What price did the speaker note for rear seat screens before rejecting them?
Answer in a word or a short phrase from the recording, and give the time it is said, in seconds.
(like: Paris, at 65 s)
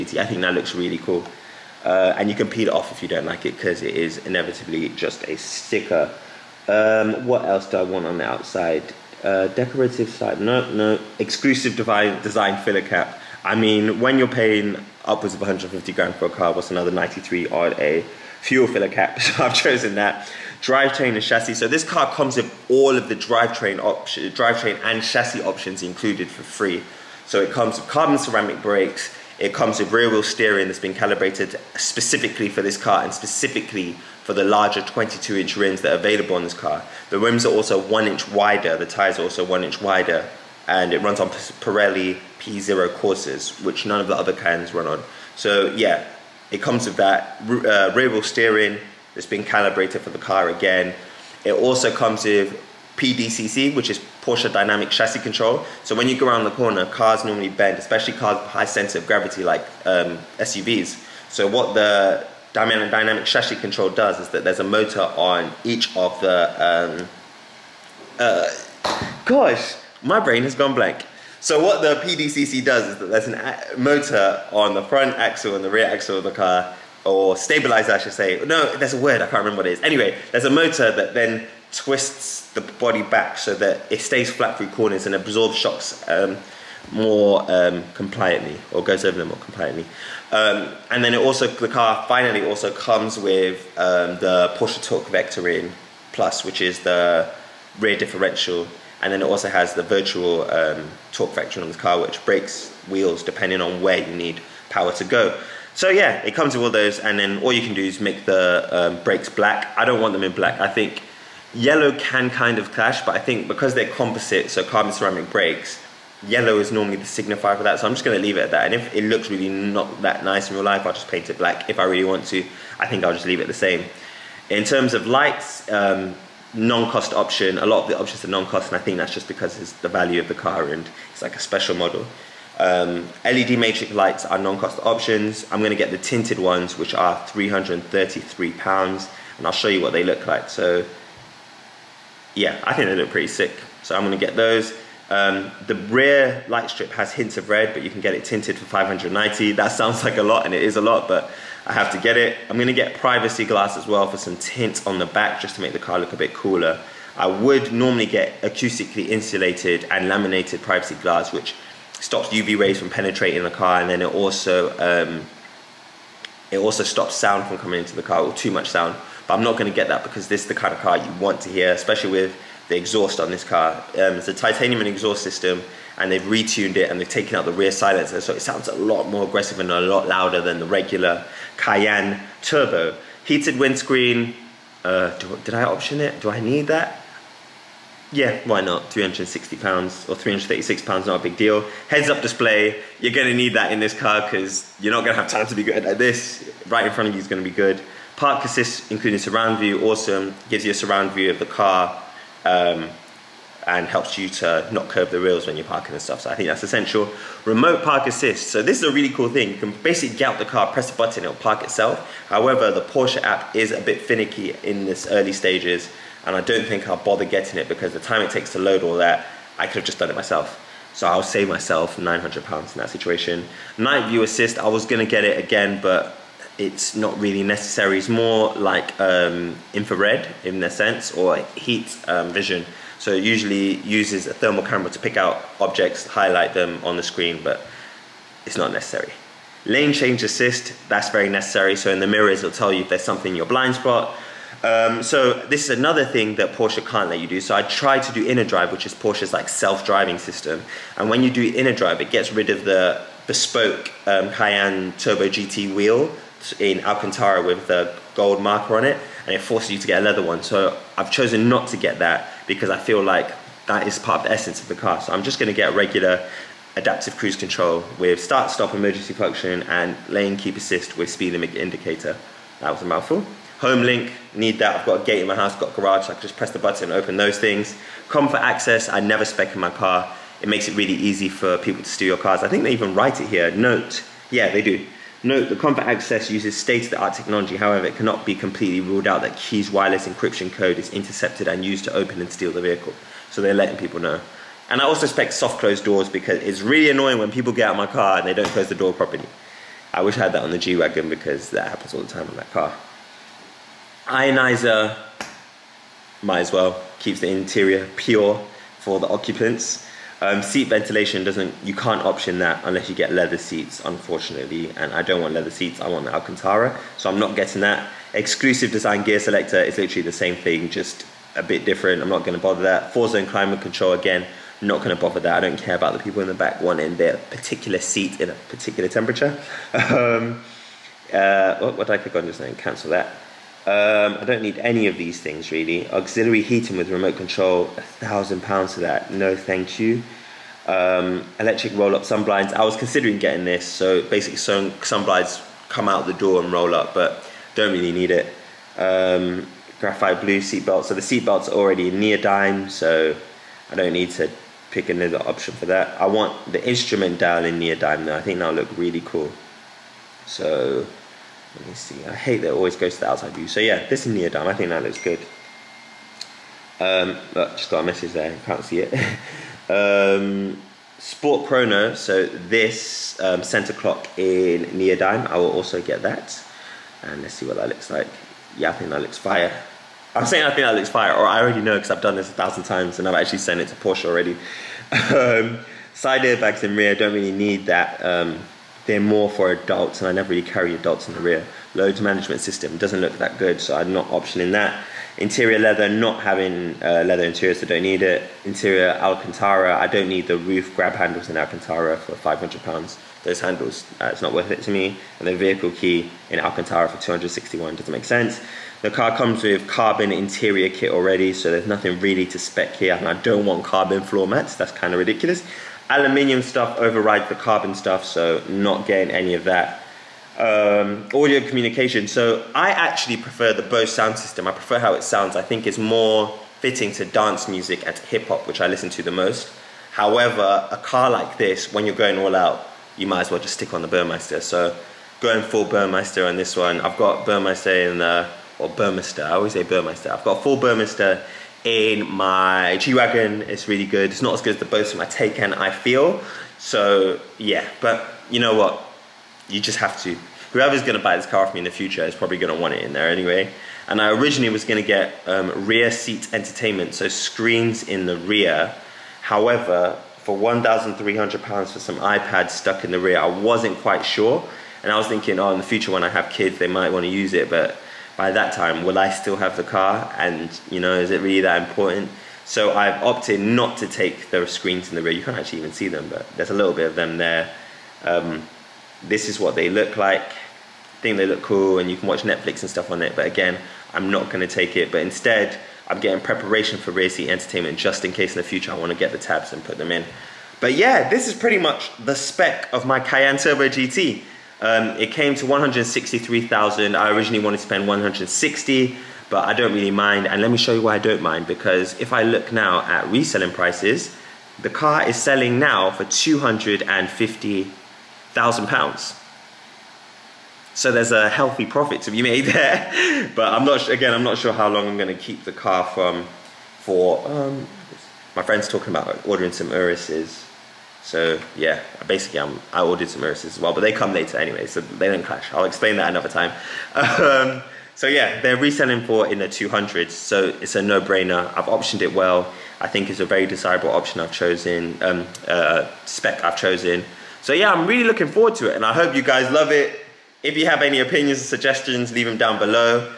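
£1,300, at 460 s.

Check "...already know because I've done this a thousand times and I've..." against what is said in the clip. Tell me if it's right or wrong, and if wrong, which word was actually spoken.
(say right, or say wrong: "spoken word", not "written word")
right.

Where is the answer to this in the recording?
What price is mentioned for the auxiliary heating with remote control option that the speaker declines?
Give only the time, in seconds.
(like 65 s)
337 s.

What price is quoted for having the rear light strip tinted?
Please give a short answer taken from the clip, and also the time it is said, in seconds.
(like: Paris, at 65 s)
£590, at 148 s.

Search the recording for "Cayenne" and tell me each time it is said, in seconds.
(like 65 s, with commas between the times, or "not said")
181 s, 254 s, 492 s.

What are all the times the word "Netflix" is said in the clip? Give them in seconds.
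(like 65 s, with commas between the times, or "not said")
482 s.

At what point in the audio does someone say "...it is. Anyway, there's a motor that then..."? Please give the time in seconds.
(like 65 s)
79 s.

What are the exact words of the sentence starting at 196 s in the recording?
Right in front of you is gonna be good.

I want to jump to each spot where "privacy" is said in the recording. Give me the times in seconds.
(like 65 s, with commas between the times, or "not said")
152 s, 160 s.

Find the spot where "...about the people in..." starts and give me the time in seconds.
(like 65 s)
325 s.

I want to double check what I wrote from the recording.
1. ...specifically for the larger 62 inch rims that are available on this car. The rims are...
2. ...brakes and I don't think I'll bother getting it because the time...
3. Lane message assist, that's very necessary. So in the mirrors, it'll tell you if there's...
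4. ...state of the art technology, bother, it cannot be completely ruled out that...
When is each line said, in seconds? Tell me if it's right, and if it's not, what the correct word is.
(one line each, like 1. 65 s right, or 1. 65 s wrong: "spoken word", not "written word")
1. 33 s wrong: "22", not "62"
2. 215 s wrong: "stages", not "brakes"
3. 239 s wrong: "change", not "message"
4. 286 s wrong: "however", not "bother".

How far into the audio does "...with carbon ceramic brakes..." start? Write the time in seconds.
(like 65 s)
27 s.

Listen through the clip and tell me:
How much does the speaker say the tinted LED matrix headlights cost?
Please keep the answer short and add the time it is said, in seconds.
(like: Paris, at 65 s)
£333, at 137 s.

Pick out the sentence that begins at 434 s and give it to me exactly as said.
So going full Burmeister on this one.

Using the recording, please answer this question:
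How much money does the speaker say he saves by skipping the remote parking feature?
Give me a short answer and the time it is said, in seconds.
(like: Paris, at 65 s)
£900, at 221 s.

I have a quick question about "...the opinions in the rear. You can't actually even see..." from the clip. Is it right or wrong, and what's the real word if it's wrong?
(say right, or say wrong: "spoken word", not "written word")
wrong: "screens", not "opinions".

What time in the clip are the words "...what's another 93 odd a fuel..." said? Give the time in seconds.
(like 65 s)
16 s.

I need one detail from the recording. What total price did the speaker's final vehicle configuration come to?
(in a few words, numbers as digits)
163,000.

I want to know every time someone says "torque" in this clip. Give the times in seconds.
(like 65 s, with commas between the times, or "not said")
94 s, 101 s.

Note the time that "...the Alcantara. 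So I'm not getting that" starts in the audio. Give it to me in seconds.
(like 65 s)
316 s.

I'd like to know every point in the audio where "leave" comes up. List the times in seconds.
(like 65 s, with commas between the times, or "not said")
118 s, 123 s, 542 s.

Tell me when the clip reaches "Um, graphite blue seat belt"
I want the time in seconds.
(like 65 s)
348 s.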